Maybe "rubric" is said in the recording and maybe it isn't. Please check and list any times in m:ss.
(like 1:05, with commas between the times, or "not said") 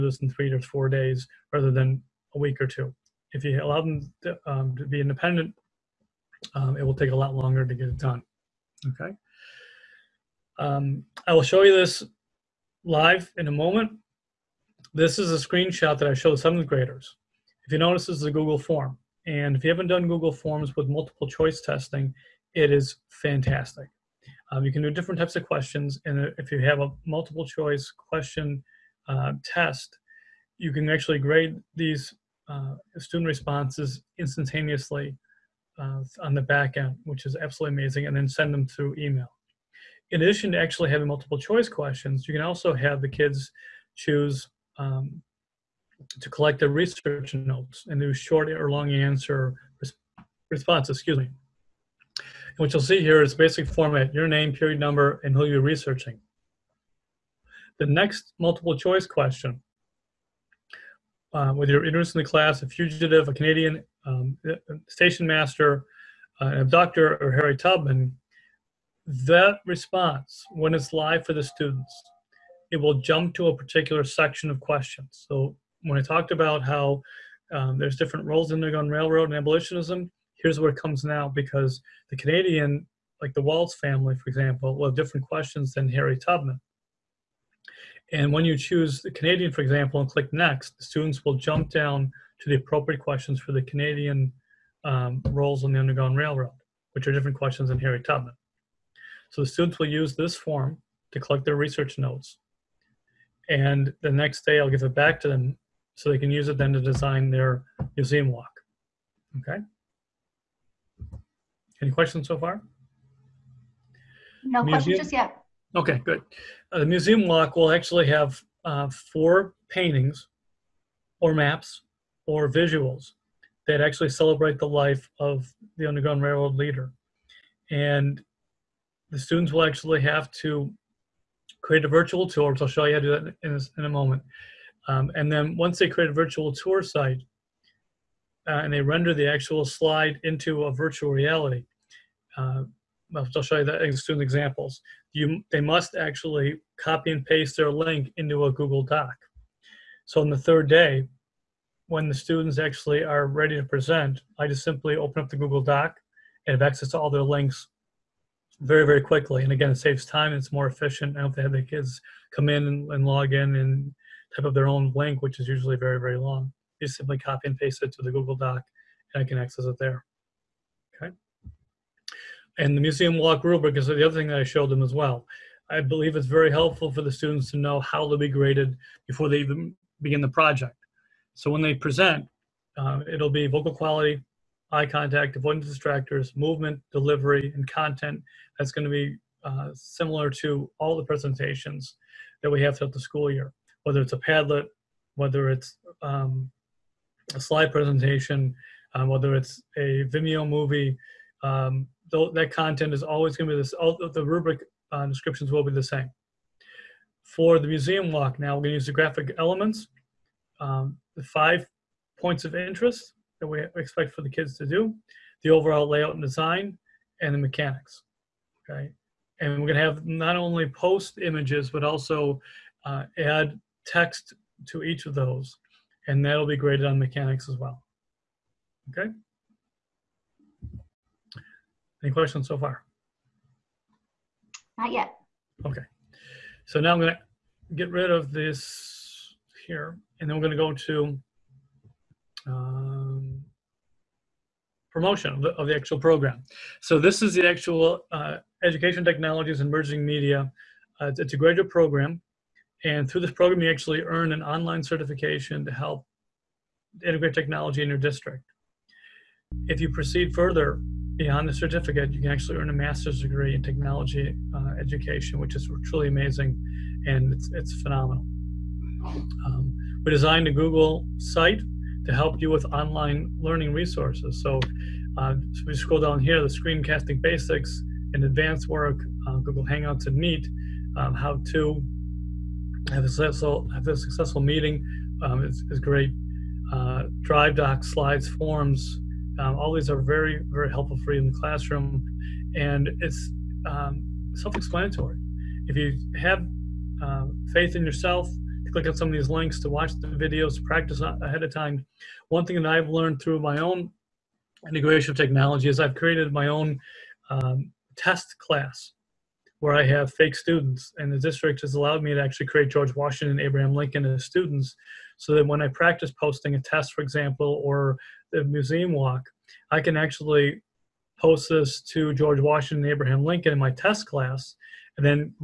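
2:53, 3:24.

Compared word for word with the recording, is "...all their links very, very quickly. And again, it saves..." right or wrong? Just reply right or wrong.
right.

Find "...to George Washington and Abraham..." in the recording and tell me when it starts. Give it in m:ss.
5:21.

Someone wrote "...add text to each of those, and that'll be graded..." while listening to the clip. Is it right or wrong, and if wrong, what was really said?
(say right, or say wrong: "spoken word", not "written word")
right.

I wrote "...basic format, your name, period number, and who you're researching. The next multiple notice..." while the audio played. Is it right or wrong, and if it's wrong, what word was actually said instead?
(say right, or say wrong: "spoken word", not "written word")
wrong: "choice", not "notice".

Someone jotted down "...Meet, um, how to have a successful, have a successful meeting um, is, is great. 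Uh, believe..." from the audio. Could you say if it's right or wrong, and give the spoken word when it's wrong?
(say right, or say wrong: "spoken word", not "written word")
wrong: "drive", not "believe".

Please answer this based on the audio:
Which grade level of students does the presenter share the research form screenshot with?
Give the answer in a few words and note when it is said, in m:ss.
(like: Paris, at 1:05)
seventh graders, at 0:16.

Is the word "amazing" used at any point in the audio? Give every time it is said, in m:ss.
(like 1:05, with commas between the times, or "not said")
0:37, 4:26.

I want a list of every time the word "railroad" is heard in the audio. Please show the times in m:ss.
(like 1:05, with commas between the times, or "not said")
1:18, 1:36, 2:06.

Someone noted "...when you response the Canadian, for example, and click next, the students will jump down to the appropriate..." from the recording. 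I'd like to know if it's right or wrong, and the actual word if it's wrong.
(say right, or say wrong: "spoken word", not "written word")
wrong: "choose", not "response".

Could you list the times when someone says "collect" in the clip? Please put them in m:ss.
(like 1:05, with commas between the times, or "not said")
0:46, 1:41.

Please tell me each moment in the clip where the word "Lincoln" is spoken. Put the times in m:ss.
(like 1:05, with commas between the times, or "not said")
5:13, 5:23.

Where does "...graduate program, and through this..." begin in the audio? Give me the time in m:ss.
4:11.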